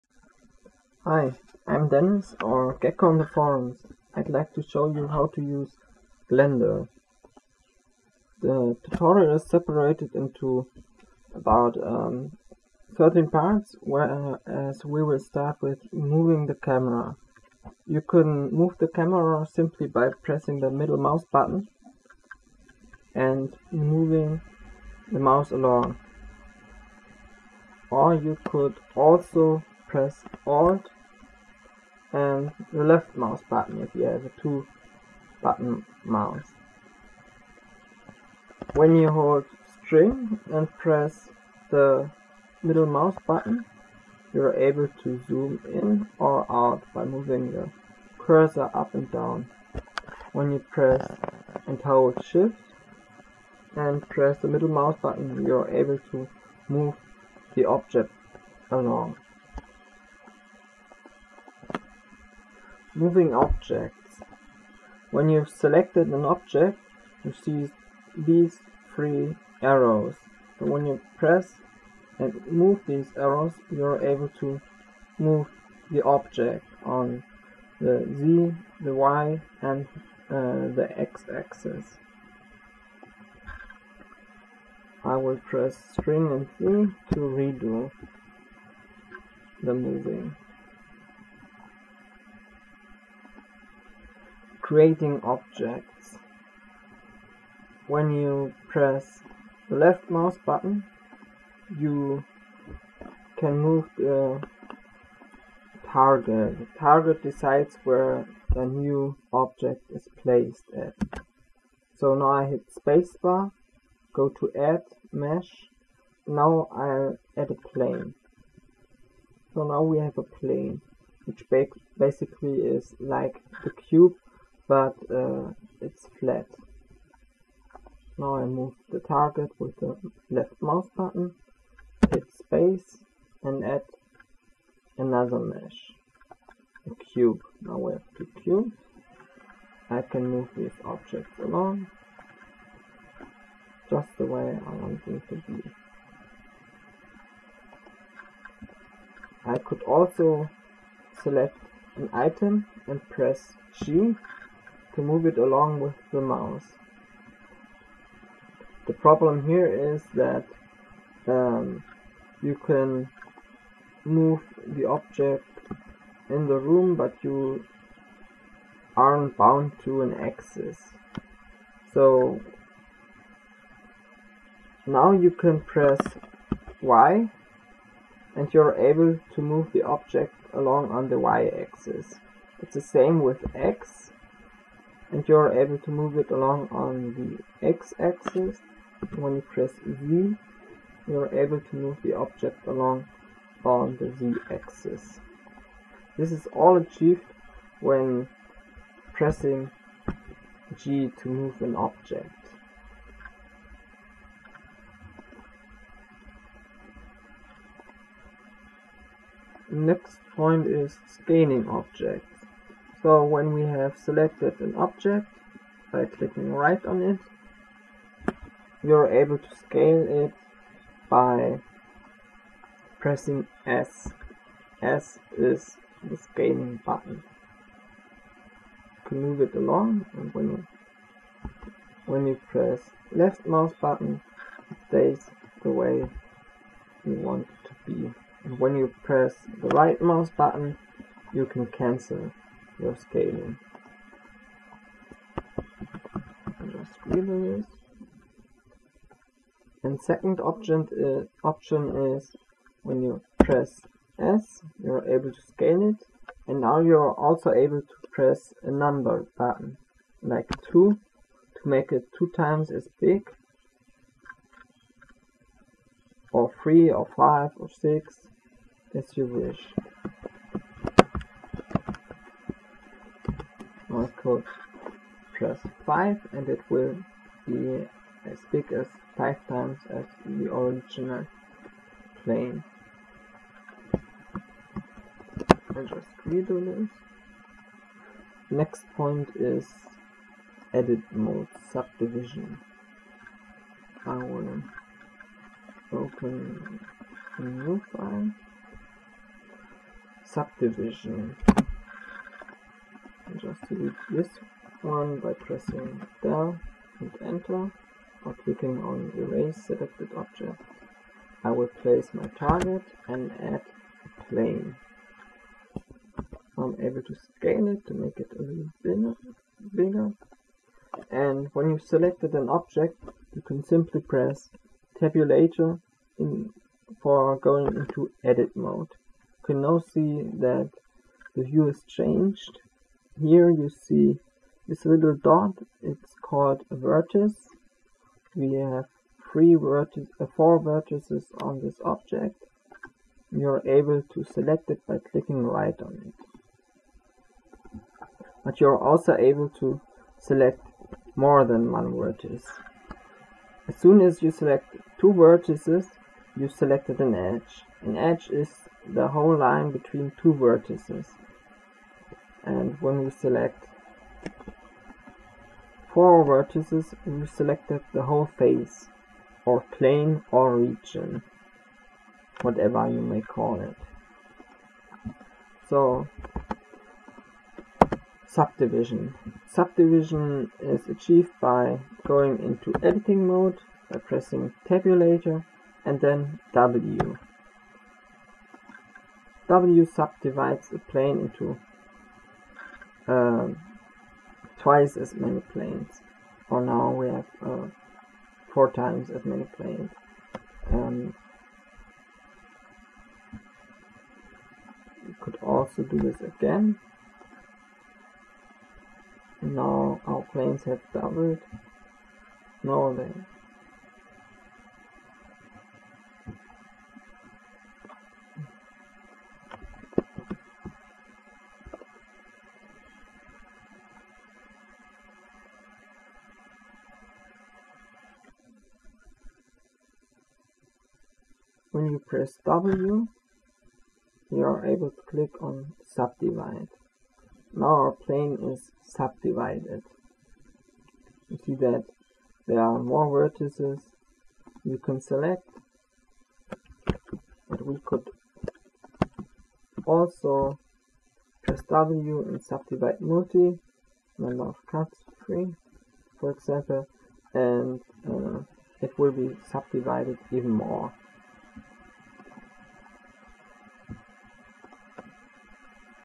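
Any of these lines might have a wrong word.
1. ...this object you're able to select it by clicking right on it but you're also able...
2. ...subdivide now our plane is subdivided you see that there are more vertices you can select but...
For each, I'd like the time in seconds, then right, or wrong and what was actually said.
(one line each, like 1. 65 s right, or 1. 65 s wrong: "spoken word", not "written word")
1. 341 s right
2. 435 s right.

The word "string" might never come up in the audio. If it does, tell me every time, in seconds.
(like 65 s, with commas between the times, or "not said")
39 s, 85 s.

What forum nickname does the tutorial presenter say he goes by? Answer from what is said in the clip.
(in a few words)
Gecko.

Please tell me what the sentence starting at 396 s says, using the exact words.
For now, we have uh, four times as many planes.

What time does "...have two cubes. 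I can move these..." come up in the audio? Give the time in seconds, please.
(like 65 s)
137 s.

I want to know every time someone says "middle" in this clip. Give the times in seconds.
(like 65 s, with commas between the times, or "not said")
20 s, 42 s, 54 s.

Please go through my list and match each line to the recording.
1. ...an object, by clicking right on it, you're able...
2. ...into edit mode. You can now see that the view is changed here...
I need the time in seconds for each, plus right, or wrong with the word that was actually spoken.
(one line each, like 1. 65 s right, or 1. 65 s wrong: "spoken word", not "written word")
1. 214 s right
2. 327 s right.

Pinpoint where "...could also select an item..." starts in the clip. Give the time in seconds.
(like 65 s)
149 s.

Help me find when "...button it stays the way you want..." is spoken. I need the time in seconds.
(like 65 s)
233 s.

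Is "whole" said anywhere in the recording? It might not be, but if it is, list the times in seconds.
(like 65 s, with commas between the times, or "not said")
359 s, 368 s.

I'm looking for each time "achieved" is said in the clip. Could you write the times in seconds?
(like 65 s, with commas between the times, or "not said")
196 s, 380 s.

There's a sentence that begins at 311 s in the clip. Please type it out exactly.
I will place my target and add a plane.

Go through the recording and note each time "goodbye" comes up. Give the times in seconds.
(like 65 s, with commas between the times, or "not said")
not said.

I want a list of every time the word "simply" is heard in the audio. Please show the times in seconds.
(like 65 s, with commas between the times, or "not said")
19 s, 323 s.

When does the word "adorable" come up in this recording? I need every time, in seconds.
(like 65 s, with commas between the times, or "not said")
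not said.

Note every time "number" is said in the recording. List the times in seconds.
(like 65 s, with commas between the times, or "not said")
258 s, 454 s.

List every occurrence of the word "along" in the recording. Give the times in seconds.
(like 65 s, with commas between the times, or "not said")
25 s, 58 s, 141 s, 155 s, 180 s, 186 s, 192 s, 229 s.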